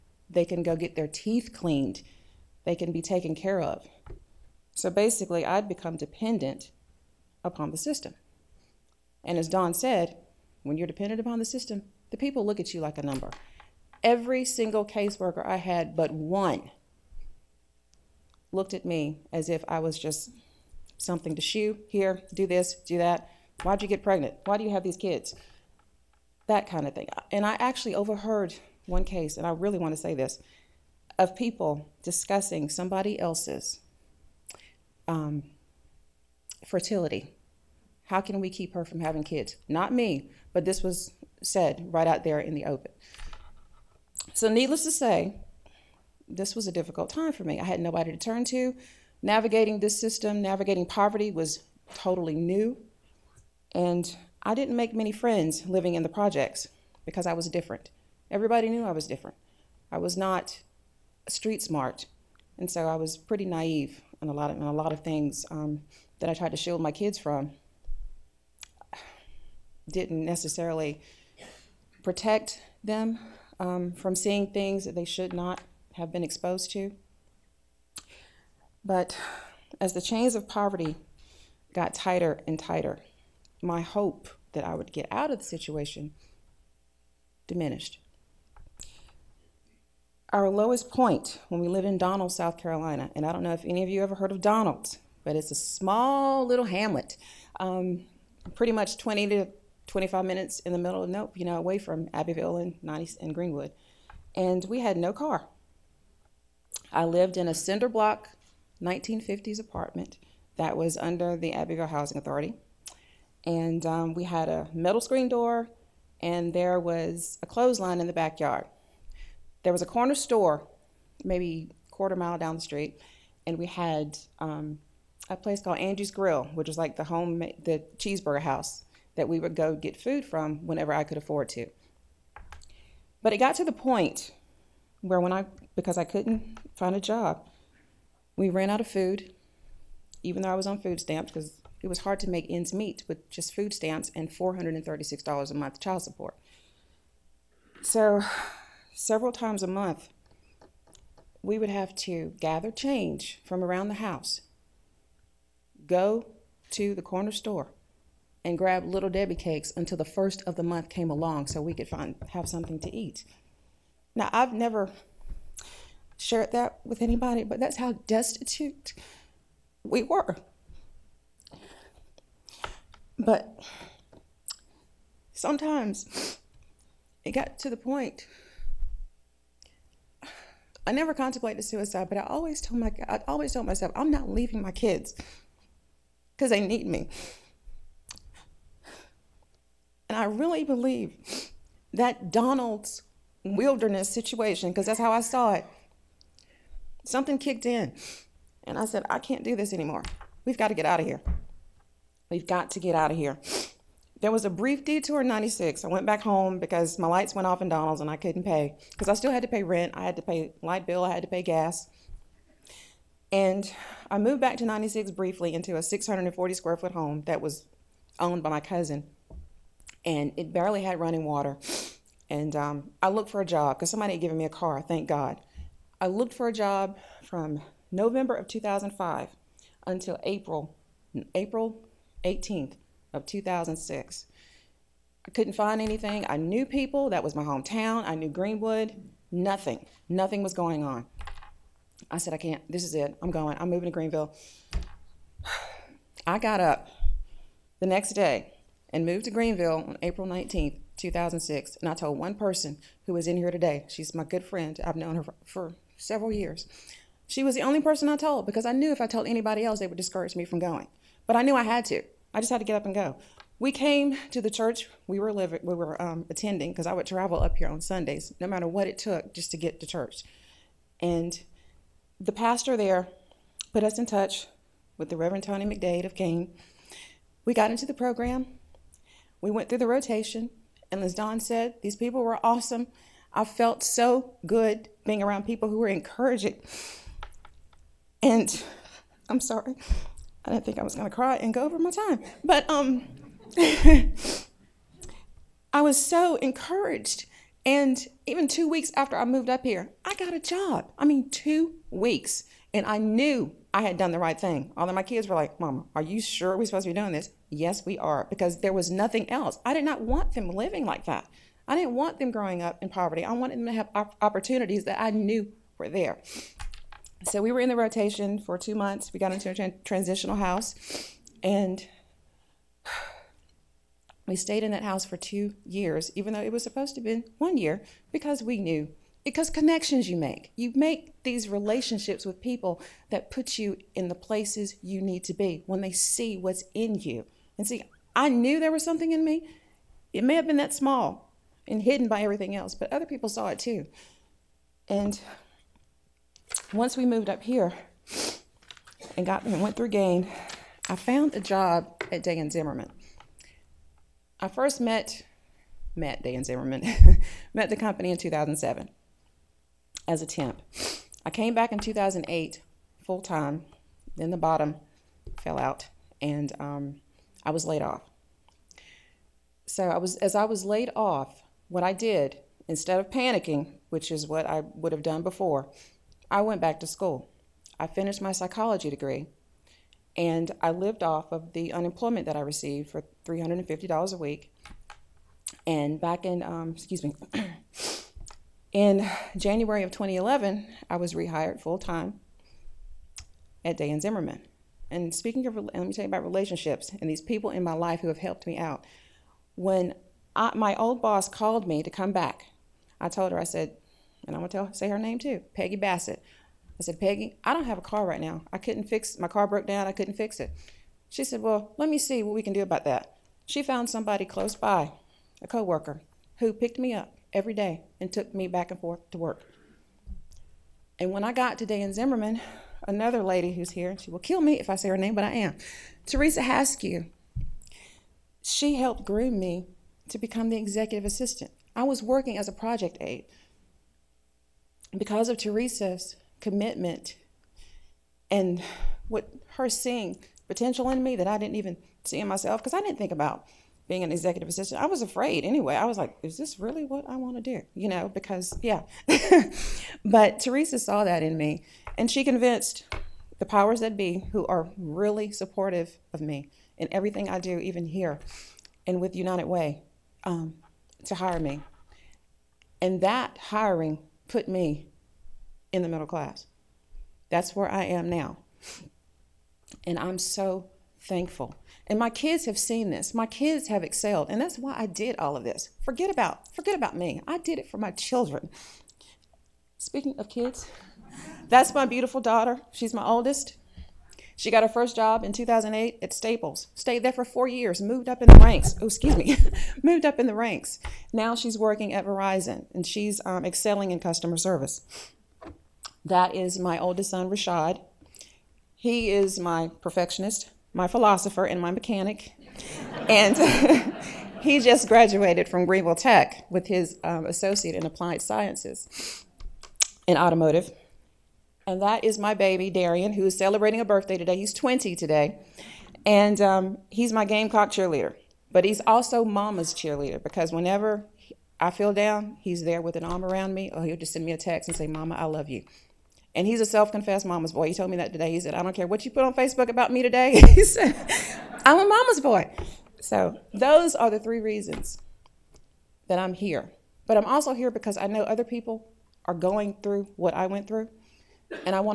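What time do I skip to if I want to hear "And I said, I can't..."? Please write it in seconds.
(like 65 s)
198 s.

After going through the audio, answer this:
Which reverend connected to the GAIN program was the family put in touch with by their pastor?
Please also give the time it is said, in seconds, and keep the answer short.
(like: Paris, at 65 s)
Tony McDade, at 275 s.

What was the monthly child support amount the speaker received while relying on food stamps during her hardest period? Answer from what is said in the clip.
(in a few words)
$436.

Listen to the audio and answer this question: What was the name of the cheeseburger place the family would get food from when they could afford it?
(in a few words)
Angie's Grill.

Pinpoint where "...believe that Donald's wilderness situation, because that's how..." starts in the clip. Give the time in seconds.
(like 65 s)
190 s.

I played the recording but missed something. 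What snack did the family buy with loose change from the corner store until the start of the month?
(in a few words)
Little Debbie cakes.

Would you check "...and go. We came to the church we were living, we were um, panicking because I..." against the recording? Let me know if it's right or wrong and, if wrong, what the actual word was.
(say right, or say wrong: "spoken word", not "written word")
wrong: "attending", not "panicking".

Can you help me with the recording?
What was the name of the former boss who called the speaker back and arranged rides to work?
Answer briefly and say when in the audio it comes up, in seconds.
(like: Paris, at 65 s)
Peggy Bassett, at 405 s.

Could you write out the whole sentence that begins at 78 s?
But as the chains of poverty got tighter and tighter, my hope that I would get out of the situation diminished.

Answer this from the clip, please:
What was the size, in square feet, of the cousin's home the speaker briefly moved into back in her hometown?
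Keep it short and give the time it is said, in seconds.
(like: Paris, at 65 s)
640, at 215 s.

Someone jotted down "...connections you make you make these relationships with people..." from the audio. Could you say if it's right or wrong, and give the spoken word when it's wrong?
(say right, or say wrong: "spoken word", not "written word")
right.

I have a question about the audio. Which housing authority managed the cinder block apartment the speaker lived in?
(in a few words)
Abbeville Housing Authority.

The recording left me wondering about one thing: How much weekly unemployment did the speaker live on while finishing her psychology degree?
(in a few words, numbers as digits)
$350.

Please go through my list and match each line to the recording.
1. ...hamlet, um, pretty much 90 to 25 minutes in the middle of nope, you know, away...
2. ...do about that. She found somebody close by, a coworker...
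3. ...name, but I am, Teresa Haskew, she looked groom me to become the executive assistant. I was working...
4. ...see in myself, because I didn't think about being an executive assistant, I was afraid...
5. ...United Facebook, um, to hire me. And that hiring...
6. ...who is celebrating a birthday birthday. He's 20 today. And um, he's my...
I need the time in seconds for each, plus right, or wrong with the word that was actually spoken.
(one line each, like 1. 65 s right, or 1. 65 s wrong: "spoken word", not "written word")
1. 96 s wrong: "20", not "90"
2. 412 s right
3. 424 s wrong: "helped", not "looked"
4. 442 s right
5. 459 s wrong: "Way", not "Facebook"
6. 513 s wrong: "today", not "birthday".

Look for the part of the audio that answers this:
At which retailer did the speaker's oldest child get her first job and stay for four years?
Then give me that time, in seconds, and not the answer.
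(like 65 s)
486 s.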